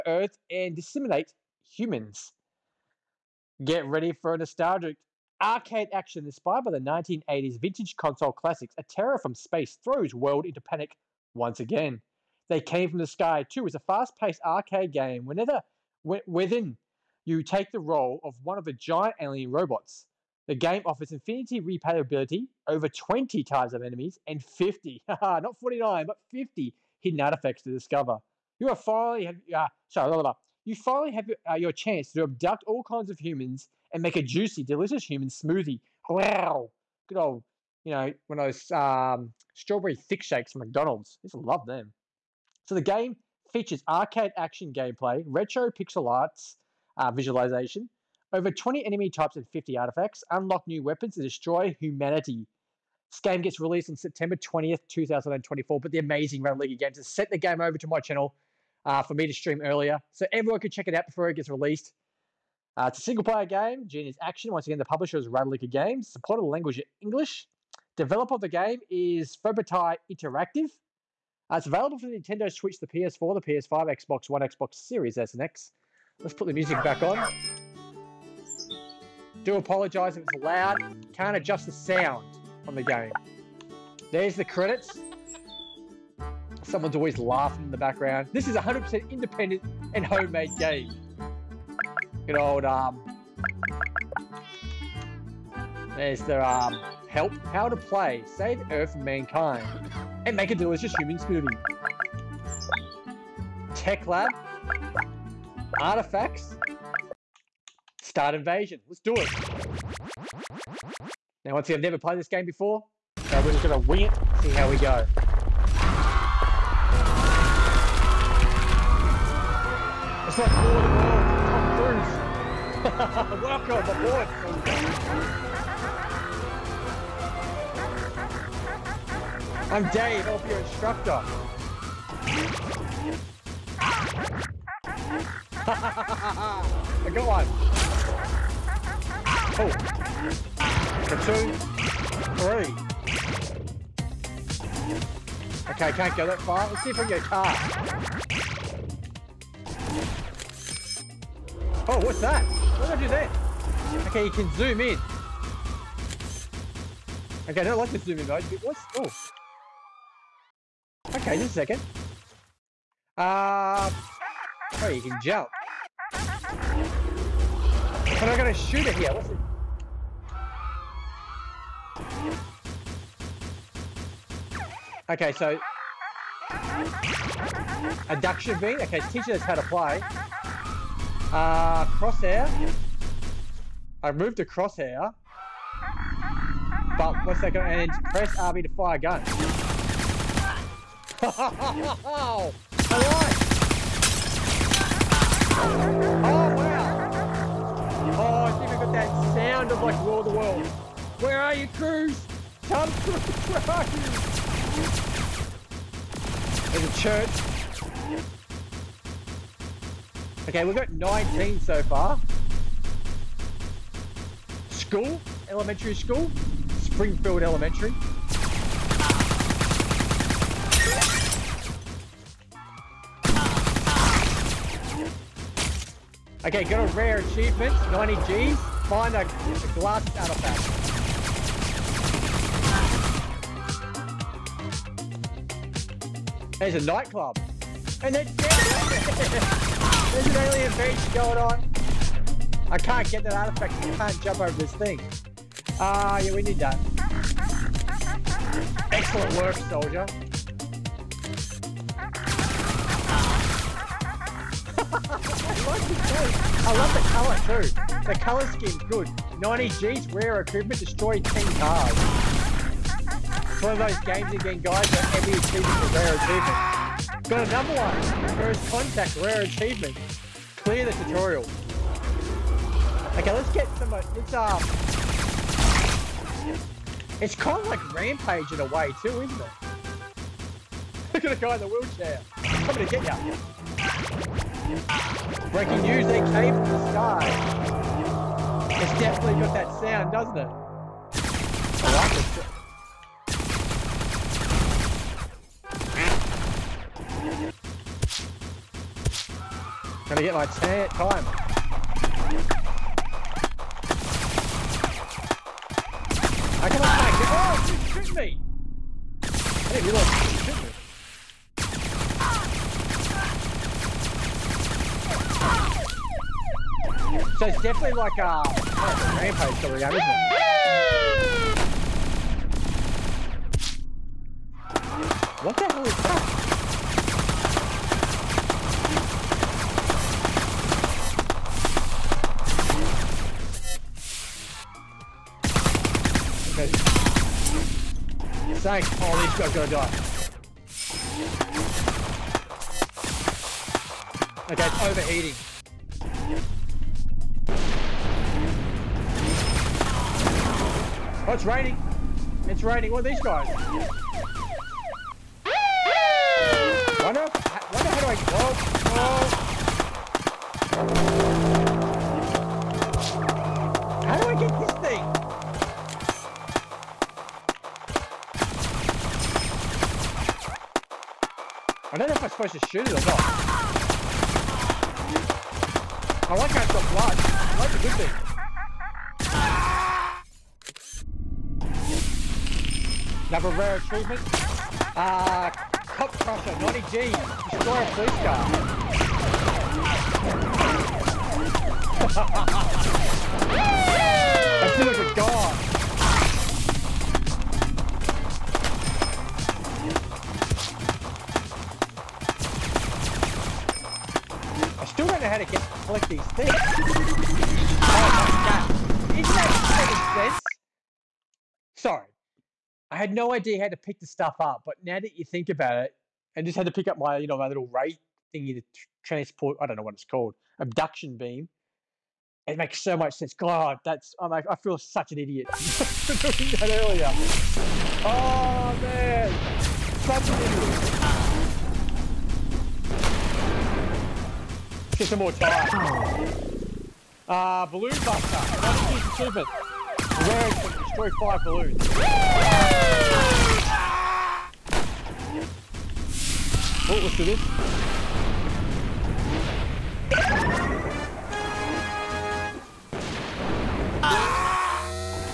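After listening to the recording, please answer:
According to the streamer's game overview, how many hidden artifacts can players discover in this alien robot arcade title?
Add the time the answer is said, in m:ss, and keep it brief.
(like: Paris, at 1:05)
50, at 0:26.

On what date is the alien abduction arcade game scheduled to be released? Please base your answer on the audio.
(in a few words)
September 20th, 2024.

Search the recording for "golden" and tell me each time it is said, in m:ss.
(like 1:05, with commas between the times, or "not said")
not said.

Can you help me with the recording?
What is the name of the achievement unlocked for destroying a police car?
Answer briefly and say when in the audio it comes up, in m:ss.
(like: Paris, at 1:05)
Cop Crusher, at 6:25.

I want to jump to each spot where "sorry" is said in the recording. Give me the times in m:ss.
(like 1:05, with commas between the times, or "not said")
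0:29, 6:51.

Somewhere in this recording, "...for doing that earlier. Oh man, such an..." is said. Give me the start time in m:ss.
7:05.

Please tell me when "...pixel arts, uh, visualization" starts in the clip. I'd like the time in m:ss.
0:45.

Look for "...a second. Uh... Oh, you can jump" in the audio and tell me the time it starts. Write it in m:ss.
2:41.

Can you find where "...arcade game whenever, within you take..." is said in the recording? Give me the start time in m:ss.
0:14.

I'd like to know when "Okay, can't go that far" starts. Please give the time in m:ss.
2:25.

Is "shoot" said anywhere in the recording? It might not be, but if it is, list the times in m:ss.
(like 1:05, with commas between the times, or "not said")
2:48, 6:12.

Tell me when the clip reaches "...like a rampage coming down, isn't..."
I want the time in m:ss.
5:18.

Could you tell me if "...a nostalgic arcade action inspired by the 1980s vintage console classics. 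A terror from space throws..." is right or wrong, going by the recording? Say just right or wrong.
right.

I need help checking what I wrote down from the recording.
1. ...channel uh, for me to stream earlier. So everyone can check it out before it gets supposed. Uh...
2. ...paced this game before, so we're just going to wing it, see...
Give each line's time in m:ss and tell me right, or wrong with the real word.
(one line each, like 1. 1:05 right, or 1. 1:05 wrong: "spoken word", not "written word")
1. 0:57 wrong: "released", not "supposed"
2. 1:51 wrong: "played", not "paced".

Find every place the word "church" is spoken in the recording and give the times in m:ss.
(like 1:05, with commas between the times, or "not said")
3:27.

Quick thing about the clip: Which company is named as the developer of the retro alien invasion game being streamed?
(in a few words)
FobTi Interactive.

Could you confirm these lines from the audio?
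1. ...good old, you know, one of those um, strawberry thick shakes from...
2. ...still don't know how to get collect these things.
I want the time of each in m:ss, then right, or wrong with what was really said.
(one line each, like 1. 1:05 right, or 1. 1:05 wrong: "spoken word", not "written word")
1. 0:37 right
2. 6:44 right.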